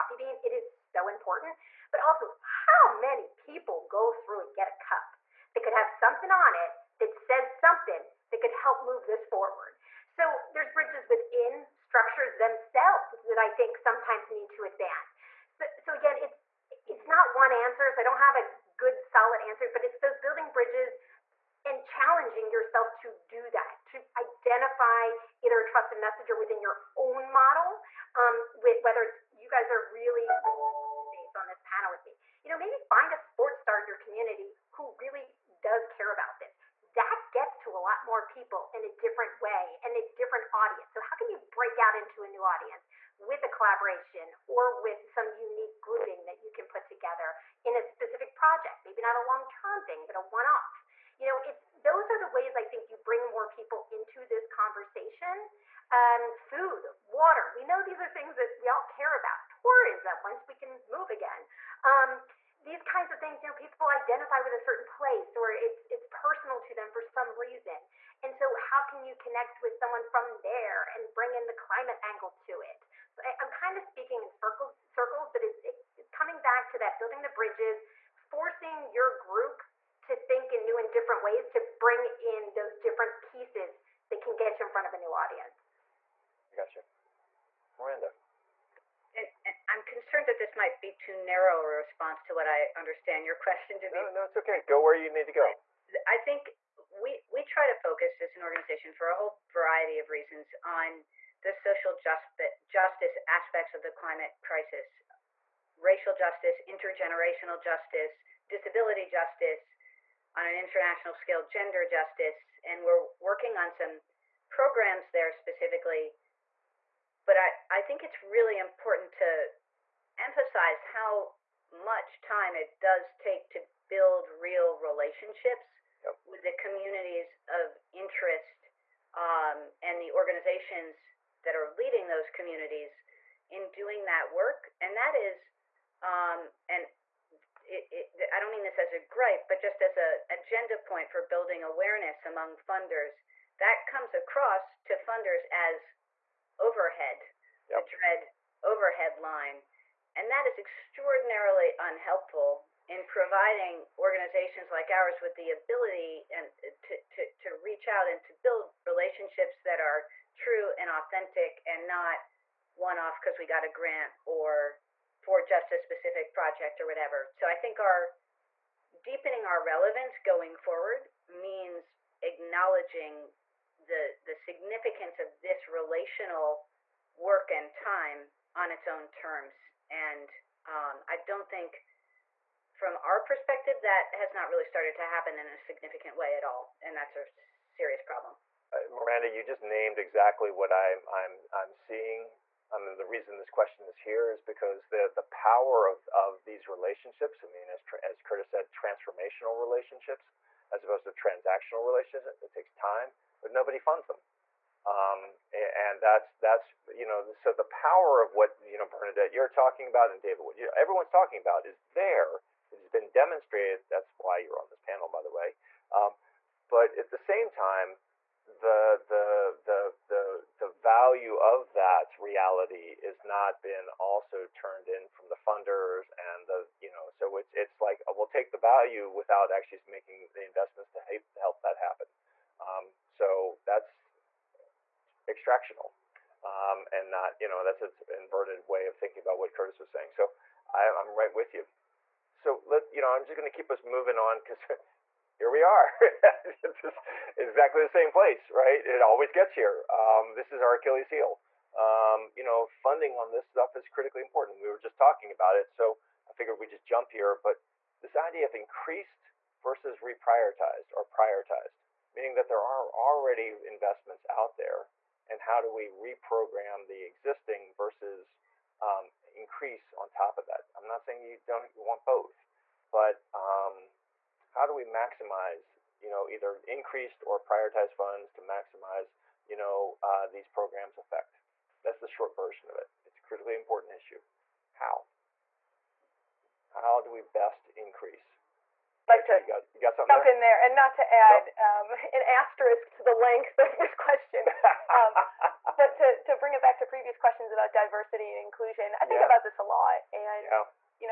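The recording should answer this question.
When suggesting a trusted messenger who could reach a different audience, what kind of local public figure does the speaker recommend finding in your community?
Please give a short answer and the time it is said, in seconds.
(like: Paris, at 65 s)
sports star, at 33 s.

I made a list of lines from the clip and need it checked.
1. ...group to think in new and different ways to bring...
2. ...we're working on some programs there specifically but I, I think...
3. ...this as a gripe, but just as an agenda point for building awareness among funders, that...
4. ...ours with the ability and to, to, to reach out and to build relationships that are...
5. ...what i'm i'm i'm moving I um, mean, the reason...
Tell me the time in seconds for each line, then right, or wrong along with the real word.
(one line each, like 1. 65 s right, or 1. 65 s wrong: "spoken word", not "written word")
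1. 79 s right
2. 112 s right
3. 138 s right
4. 154 s right
5. 190 s wrong: "seeing", not "moving".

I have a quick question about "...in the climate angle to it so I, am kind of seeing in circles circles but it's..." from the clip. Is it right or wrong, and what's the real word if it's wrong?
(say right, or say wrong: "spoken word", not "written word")
wrong: "speaking", not "seeing".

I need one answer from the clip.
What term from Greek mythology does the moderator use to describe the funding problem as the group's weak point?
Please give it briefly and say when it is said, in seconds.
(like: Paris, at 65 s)
Achilles heel, at 250 s.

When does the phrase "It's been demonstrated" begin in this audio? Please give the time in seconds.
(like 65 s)
212 s.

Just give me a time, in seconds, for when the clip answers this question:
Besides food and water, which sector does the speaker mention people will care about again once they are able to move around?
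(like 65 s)
59 s.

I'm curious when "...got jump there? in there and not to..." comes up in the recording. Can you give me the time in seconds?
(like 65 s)
289 s.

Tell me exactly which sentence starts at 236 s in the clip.
Um, and not, you know, that's an inverted way of thinking about what Curtis was saying.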